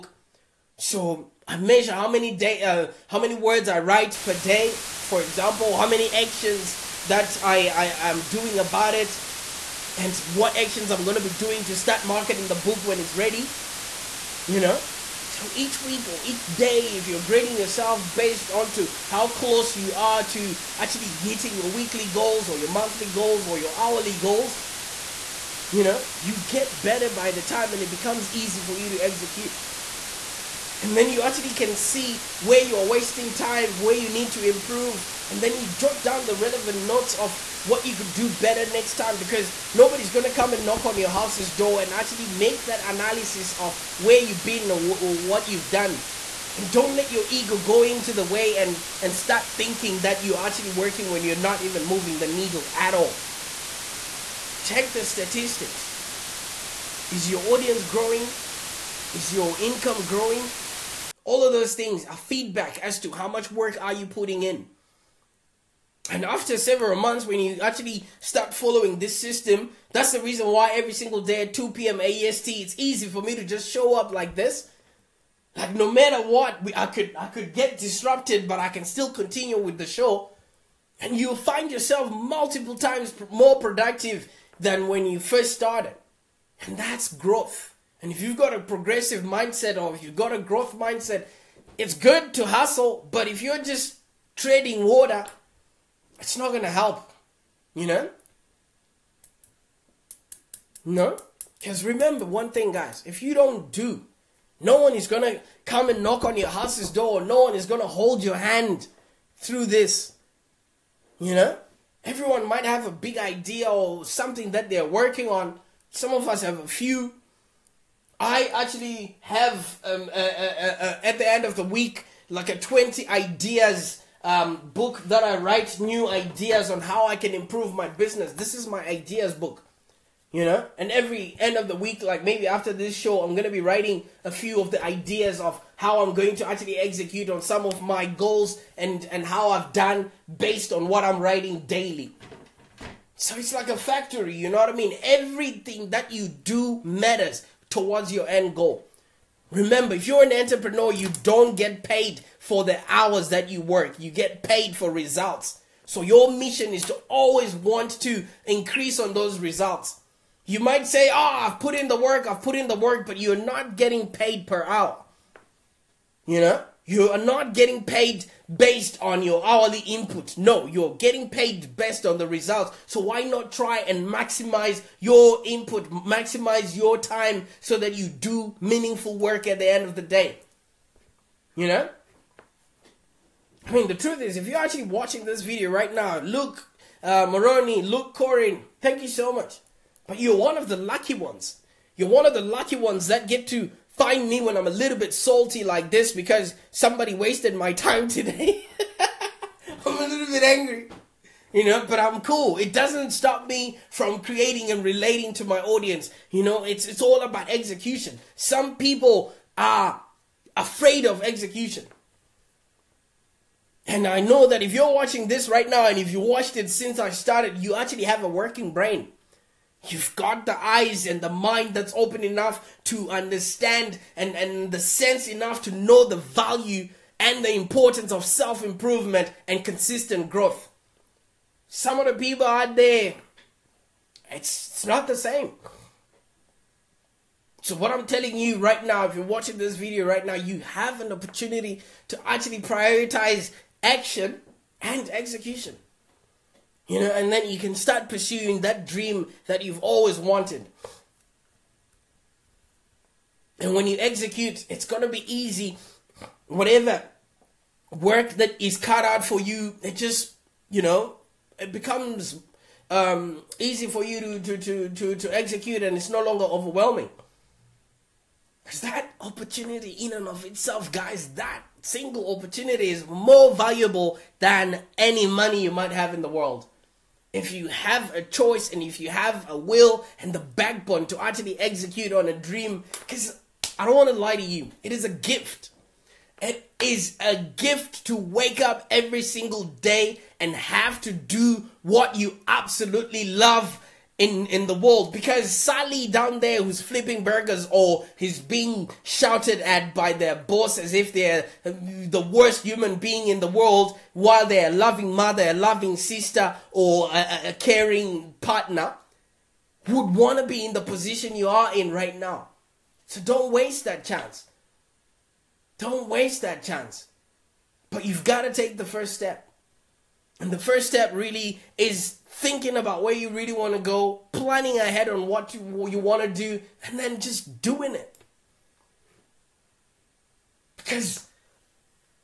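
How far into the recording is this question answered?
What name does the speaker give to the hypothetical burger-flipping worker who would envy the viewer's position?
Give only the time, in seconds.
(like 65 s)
295 s.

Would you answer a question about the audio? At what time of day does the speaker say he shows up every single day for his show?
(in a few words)
2 p.m. AST.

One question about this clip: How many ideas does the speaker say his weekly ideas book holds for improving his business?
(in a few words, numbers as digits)
20.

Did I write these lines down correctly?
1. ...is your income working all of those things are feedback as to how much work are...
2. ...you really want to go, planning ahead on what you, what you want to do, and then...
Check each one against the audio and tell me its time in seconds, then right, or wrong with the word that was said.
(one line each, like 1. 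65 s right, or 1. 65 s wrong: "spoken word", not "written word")
1. 59 s wrong: "growing", not "working"
2. 323 s right.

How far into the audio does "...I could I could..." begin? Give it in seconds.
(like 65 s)
76 s.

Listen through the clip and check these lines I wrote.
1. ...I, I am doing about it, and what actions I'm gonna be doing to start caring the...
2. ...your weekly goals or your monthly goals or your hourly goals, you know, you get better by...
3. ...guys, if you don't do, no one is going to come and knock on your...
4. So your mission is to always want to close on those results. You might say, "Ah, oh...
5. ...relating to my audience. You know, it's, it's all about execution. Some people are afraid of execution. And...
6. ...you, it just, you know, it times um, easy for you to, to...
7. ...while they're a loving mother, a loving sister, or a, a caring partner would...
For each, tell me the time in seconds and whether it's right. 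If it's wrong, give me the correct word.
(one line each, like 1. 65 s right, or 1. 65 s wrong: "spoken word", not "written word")
1. 7 s wrong: "marketing", not "caring"
2. 21 s right
3. 102 s right
4. 155 s wrong: "increase", not "close"
5. 204 s right
6. 259 s wrong: "becomes", not "times"
7. 304 s right.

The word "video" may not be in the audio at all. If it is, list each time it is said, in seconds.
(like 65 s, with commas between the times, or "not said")
185 s, 239 s.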